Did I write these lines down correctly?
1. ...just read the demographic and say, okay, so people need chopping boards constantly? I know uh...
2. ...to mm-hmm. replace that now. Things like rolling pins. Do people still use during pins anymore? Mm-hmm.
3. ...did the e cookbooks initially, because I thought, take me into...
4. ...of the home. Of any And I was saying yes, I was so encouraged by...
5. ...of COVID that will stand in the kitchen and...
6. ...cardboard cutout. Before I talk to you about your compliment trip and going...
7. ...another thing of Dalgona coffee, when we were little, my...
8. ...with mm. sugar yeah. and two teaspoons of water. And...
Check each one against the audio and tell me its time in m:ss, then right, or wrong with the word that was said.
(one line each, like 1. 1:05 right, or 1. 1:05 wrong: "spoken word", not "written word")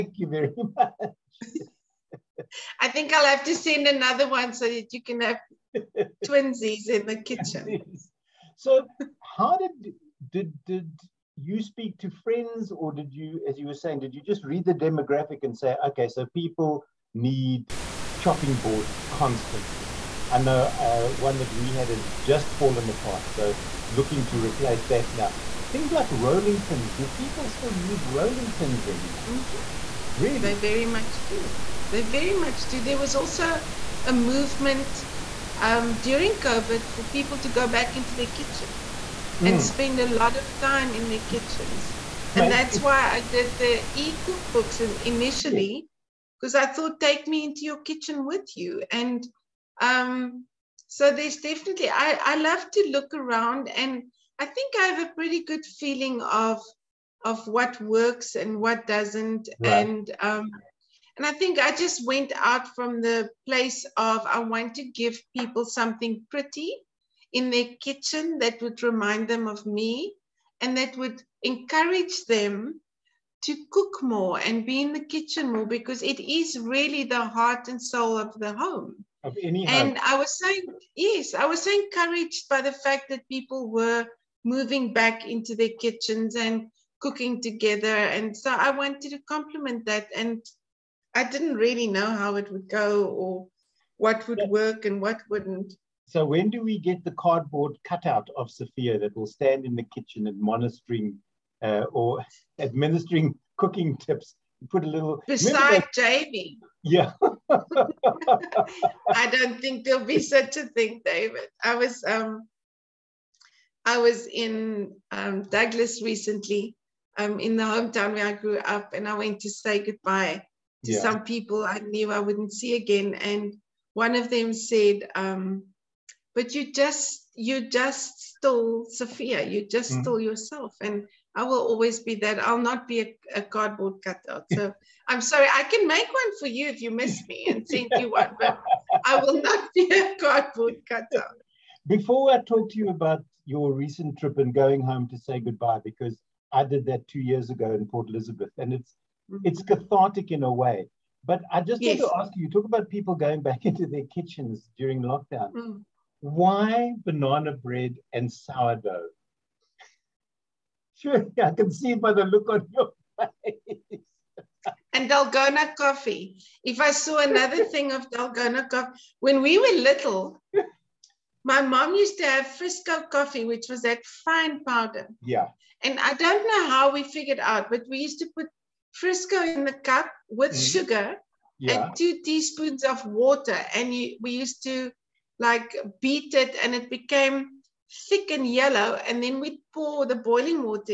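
1. 0:14 right
2. 0:24 wrong: "rolling", not "during"
3. 0:43 right
4. 1:18 right
5. 1:38 wrong: "Sophia", not "COVID"
6. 2:20 wrong: "recent", not "compliment"
7. 2:47 right
8. 3:00 right.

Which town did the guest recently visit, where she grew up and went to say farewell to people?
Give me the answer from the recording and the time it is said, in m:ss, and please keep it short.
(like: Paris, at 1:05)
Douglas, at 1:55.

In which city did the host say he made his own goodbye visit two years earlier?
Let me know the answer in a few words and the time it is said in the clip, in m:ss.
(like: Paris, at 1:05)
Port Elizabeth, at 2:27.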